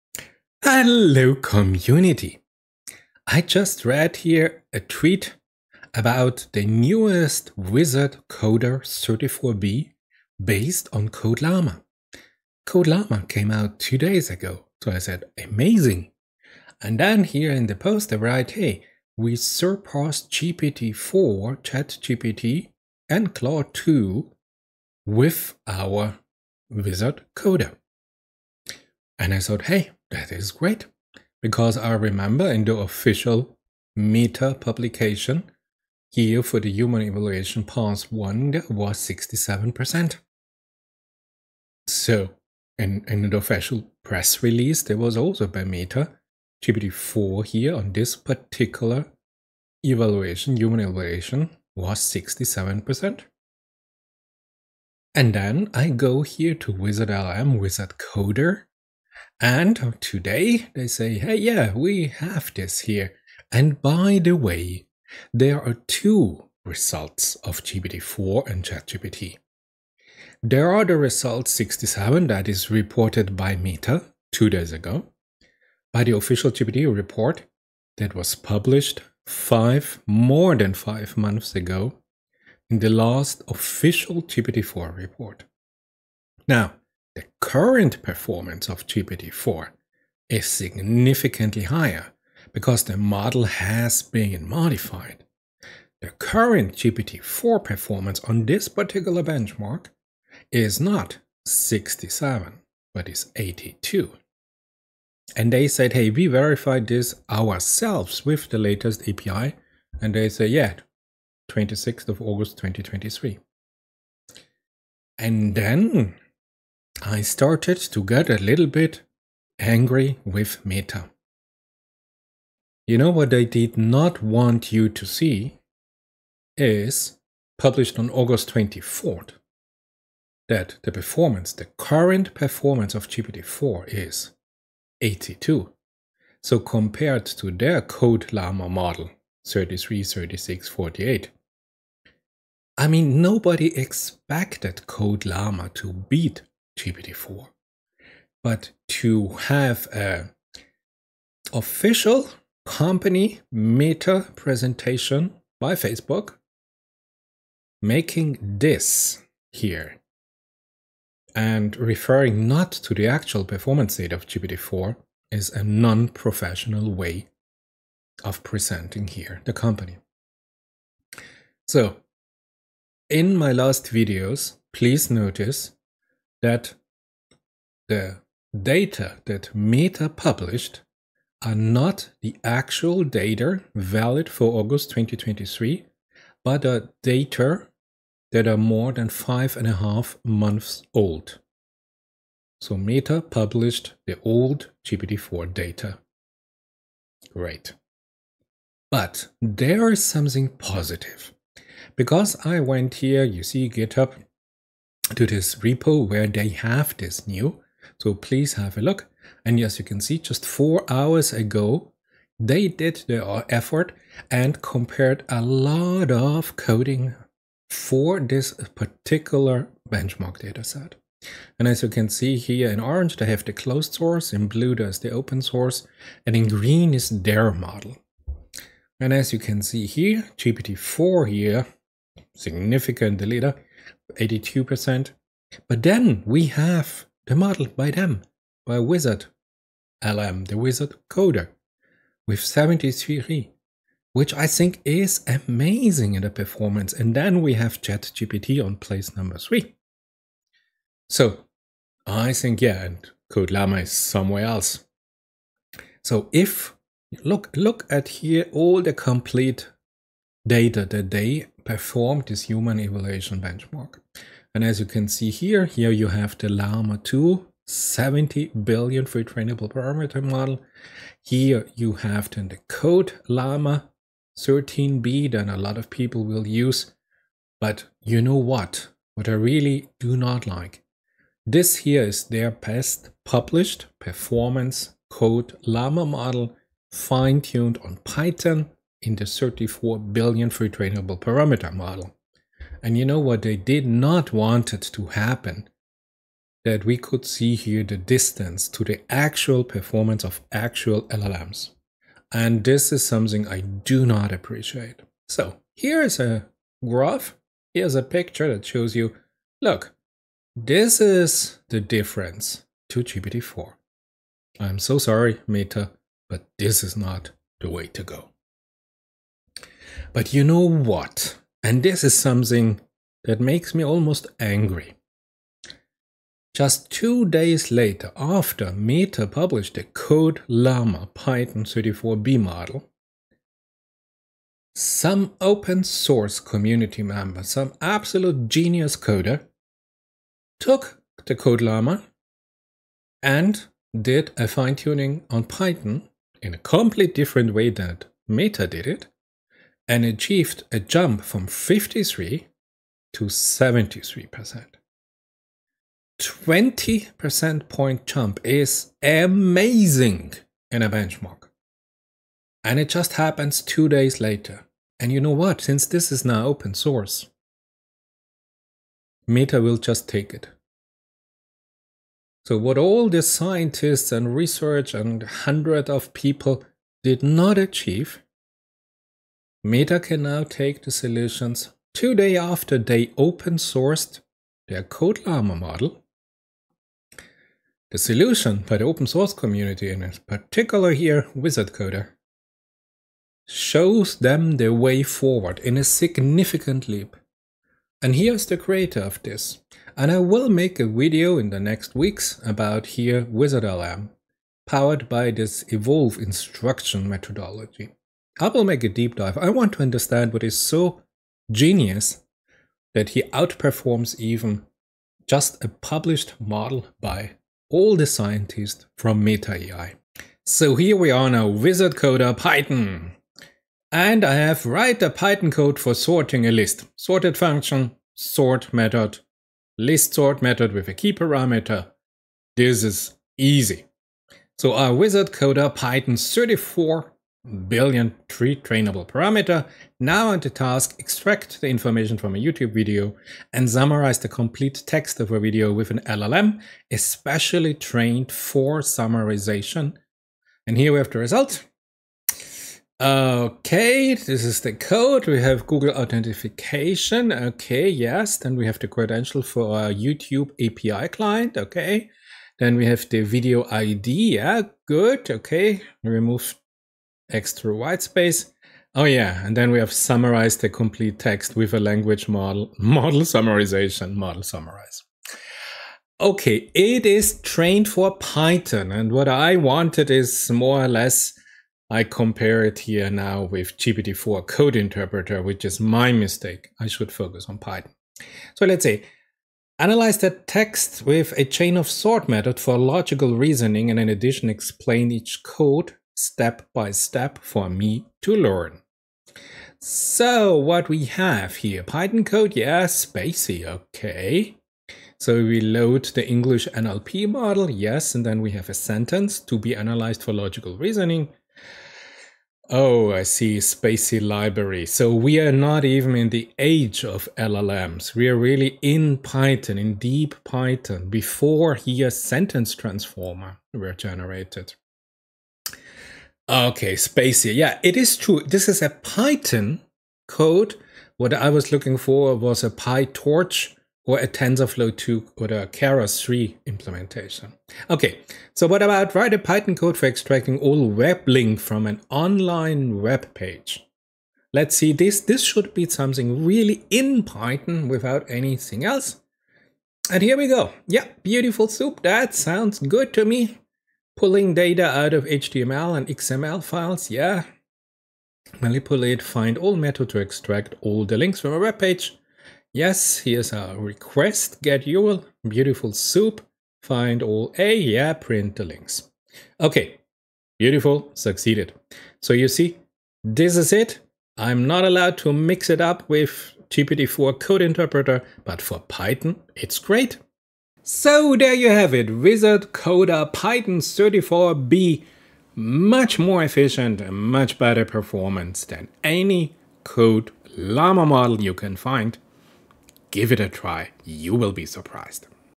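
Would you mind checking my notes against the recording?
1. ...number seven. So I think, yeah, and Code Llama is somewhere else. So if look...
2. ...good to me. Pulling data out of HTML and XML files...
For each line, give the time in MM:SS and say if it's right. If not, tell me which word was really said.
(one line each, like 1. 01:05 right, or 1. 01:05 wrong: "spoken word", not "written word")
1. 04:09 wrong: "three", not "seven"
2. 09:12 right.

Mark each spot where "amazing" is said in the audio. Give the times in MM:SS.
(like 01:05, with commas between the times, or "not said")
00:15, 04:05, 05:59.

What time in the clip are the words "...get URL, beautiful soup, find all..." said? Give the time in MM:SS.
09:24.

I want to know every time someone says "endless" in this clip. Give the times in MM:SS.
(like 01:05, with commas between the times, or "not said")
not said.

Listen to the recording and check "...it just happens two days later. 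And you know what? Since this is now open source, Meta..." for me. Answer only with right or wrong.
right.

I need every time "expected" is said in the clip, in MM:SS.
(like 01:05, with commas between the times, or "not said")
02:23.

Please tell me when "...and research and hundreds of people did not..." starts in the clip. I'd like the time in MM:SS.
06:14.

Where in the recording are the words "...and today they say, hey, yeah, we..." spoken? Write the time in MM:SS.
00:59.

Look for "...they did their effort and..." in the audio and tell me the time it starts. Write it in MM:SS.
03:32.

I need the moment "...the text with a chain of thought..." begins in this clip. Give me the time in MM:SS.
08:10.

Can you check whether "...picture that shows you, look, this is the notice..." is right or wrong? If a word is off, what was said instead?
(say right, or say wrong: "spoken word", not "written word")
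wrong: "difference", not "notice".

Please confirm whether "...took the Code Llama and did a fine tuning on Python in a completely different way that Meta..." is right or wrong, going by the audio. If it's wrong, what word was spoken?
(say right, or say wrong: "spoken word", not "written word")
right.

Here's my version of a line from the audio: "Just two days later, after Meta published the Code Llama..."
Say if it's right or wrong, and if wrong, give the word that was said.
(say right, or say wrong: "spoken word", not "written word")
right.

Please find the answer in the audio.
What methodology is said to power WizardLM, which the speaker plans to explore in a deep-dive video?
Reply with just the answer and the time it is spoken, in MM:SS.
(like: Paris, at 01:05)
evolve instruction, at 06:45.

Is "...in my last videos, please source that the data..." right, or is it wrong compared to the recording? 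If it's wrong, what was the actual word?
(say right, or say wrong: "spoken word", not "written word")
wrong: "notice", not "source".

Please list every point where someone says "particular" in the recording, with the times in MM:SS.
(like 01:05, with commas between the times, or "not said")
00:48, 01:38, 03:38, 06:30.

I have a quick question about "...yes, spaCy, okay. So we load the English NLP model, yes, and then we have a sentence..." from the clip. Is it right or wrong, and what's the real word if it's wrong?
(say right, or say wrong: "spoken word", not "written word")
right.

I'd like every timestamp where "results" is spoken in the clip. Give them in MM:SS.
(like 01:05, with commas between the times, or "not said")
01:06, 01:10, 07:31.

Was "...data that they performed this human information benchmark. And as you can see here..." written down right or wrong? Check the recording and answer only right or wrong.
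wrong.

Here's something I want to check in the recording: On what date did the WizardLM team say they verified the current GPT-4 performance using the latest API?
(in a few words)
26th of August 2023.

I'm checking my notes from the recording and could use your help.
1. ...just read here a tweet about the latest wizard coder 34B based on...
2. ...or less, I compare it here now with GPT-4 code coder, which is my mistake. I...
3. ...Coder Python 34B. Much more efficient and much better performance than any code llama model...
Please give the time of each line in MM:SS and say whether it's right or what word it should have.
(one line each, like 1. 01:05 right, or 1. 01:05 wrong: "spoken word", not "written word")
1. 00:03 wrong: "newest", not "latest"
2. 08:00 wrong: "interpreter", not "coder"
3. 09:42 right.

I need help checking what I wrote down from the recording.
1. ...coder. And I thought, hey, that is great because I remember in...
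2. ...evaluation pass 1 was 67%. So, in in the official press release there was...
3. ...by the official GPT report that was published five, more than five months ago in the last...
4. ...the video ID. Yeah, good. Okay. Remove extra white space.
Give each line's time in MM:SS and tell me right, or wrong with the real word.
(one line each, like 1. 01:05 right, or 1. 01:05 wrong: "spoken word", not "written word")
1. 00:27 right
2. 00:37 right
3. 01:15 right
4. 07:43 right.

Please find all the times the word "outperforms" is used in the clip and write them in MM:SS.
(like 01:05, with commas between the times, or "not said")
06:53.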